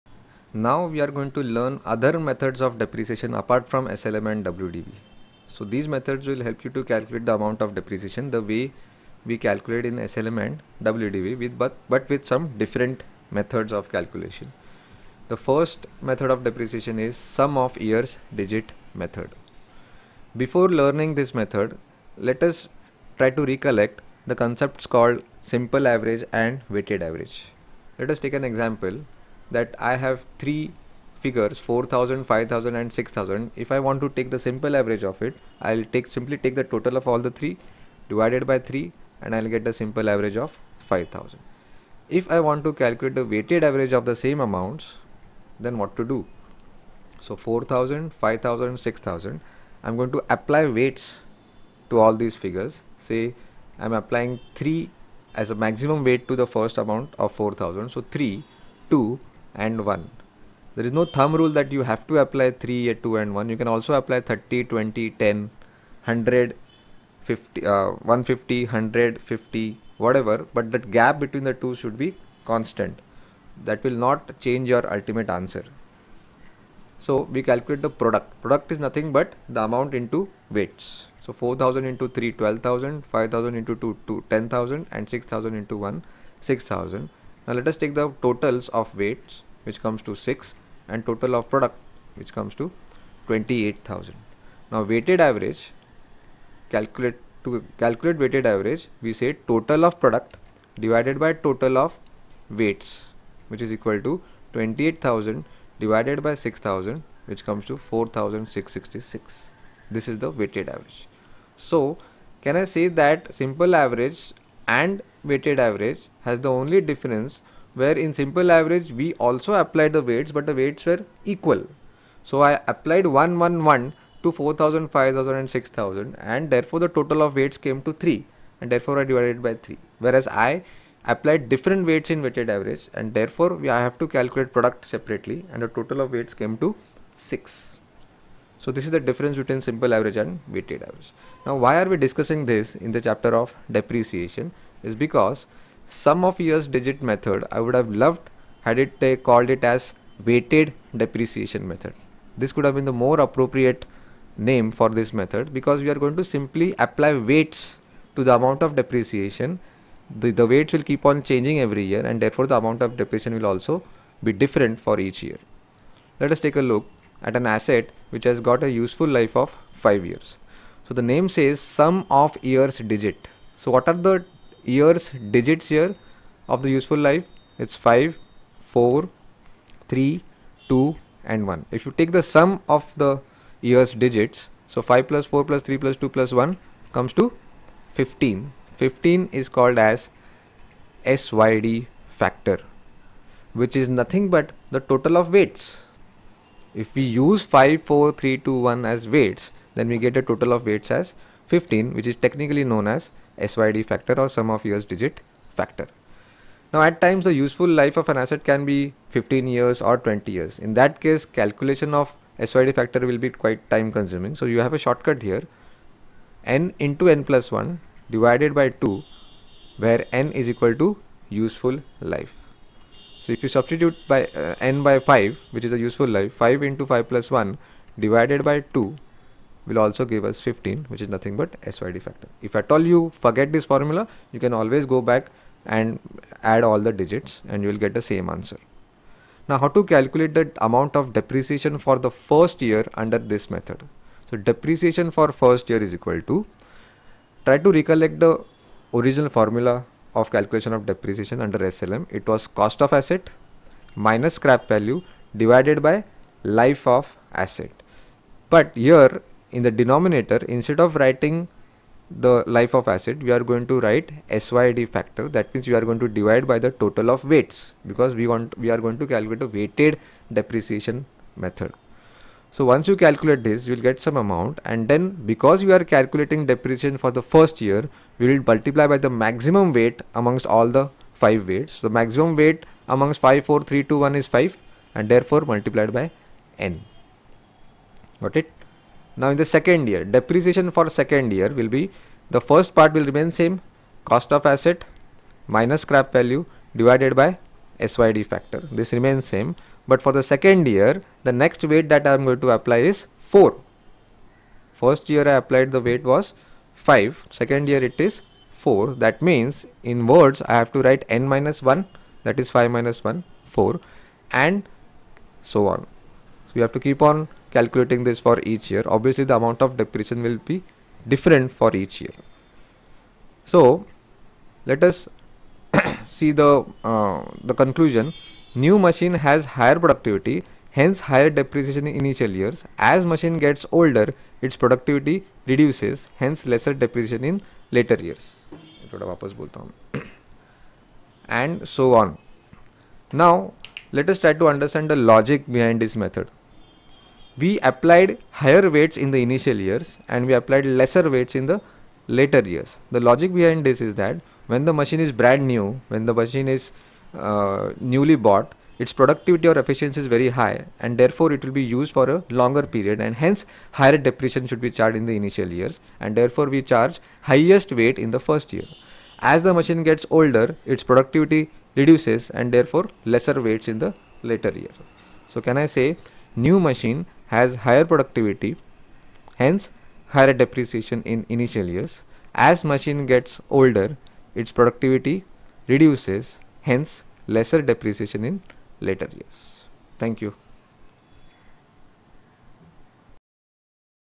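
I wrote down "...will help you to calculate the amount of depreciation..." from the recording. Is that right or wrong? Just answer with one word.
right.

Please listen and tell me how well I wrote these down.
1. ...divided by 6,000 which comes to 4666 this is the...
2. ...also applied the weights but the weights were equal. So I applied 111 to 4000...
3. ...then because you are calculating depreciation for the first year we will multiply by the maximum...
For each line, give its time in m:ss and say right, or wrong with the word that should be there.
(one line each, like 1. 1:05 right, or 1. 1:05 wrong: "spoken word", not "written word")
1. 1:45 right
2. 1:59 right
3. 4:34 right.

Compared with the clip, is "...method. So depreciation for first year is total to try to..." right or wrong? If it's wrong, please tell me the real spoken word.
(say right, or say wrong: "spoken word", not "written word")
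wrong: "equal", not "total".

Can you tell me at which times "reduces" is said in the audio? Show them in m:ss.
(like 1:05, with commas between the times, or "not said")
5:35, 6:11, 6:25.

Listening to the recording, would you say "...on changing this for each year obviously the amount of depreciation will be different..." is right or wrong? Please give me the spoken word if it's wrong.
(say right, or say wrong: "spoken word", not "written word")
wrong: "calculating", not "changing".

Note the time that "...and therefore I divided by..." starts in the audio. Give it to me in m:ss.
2:08.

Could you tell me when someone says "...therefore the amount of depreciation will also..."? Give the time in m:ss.
2:42.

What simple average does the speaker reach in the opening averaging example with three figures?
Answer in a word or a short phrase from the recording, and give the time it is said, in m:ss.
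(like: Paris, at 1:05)
5000, at 0:39.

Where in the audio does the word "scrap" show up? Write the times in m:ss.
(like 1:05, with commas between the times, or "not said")
4:14, 4:55.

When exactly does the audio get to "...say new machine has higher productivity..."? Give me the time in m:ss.
6:15.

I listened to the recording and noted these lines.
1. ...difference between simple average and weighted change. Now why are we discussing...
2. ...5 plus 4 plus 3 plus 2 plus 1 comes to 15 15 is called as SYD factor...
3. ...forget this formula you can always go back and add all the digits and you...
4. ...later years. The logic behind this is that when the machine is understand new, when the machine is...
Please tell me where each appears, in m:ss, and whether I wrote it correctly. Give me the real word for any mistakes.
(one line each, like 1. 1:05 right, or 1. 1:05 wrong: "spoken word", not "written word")
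1. 2:19 wrong: "average", not "change"
2. 3:04 right
3. 3:53 right
4. 5:52 wrong: "brand", not "understand".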